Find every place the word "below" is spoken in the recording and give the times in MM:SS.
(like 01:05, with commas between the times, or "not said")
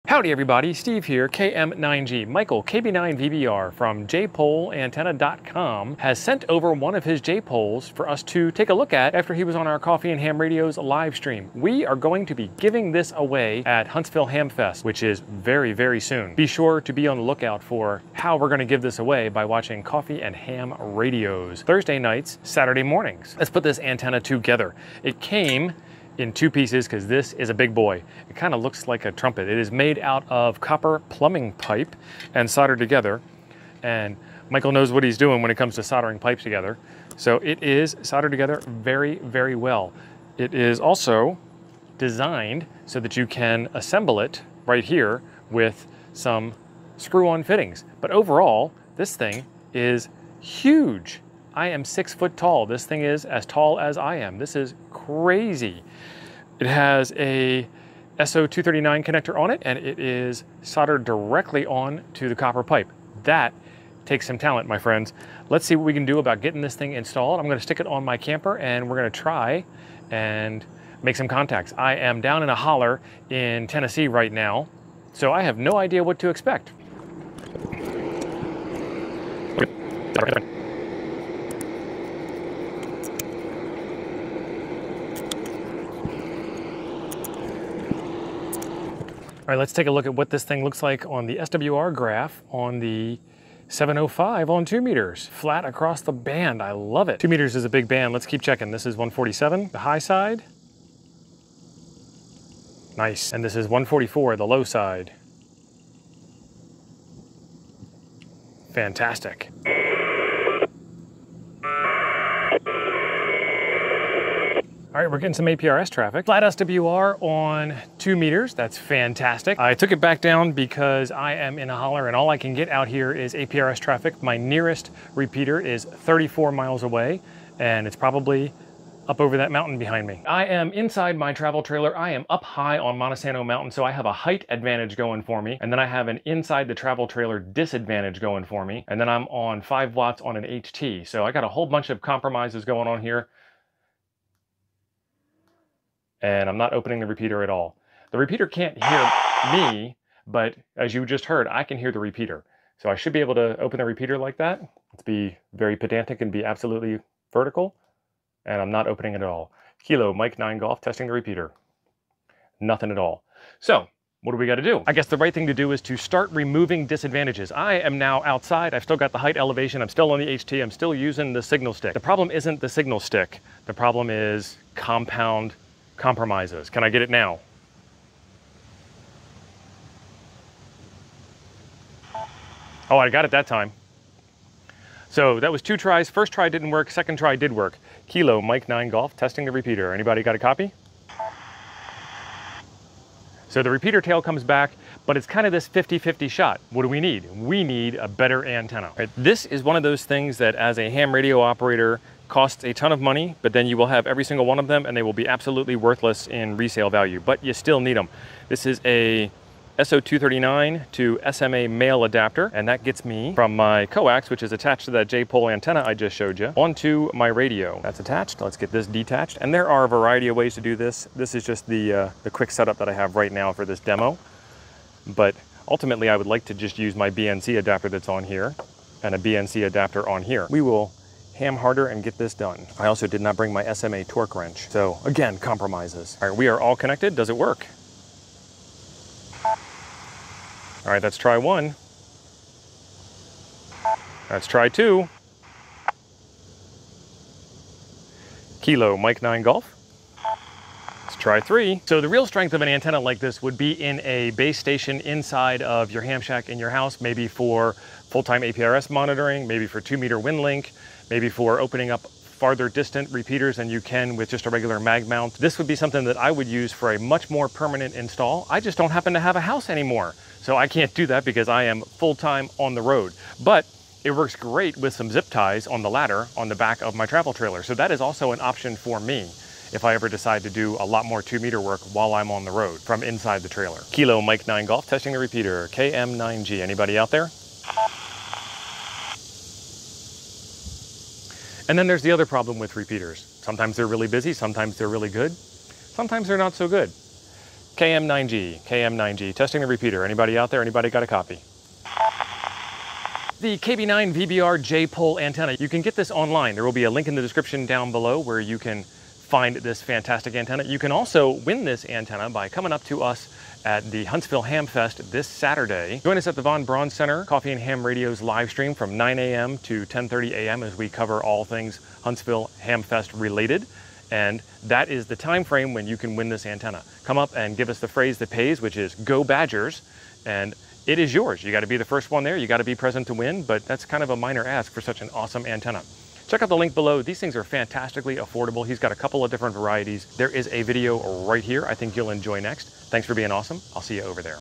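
05:07, 05:36.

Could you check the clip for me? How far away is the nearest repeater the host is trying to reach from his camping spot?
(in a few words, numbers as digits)
34 miles.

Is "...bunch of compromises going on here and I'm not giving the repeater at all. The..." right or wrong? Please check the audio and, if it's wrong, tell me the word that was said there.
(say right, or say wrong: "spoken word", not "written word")
wrong: "opening", not "giving".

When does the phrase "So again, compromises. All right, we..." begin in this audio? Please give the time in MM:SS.
03:54.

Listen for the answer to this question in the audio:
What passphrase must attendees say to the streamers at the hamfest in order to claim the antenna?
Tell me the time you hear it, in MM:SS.
05:28.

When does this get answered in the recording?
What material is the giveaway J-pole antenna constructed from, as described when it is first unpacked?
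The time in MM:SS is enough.
00:30.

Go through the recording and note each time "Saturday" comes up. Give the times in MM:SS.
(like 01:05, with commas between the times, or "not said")
00:22, 05:15.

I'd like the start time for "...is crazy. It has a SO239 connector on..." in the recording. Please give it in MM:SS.
00:54.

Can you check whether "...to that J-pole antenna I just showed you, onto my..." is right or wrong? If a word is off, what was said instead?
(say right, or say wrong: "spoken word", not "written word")
right.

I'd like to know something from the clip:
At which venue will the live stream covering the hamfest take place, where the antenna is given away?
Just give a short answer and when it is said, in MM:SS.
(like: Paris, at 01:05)
Von Braun Center, at 05:16.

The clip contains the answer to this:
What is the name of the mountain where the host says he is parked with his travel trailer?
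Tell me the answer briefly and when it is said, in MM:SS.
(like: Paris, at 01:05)
Montesano Mountain, at 02:12.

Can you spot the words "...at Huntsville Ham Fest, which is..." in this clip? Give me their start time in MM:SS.
00:13.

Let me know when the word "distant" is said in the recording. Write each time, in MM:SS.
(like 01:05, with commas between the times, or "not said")
04:22.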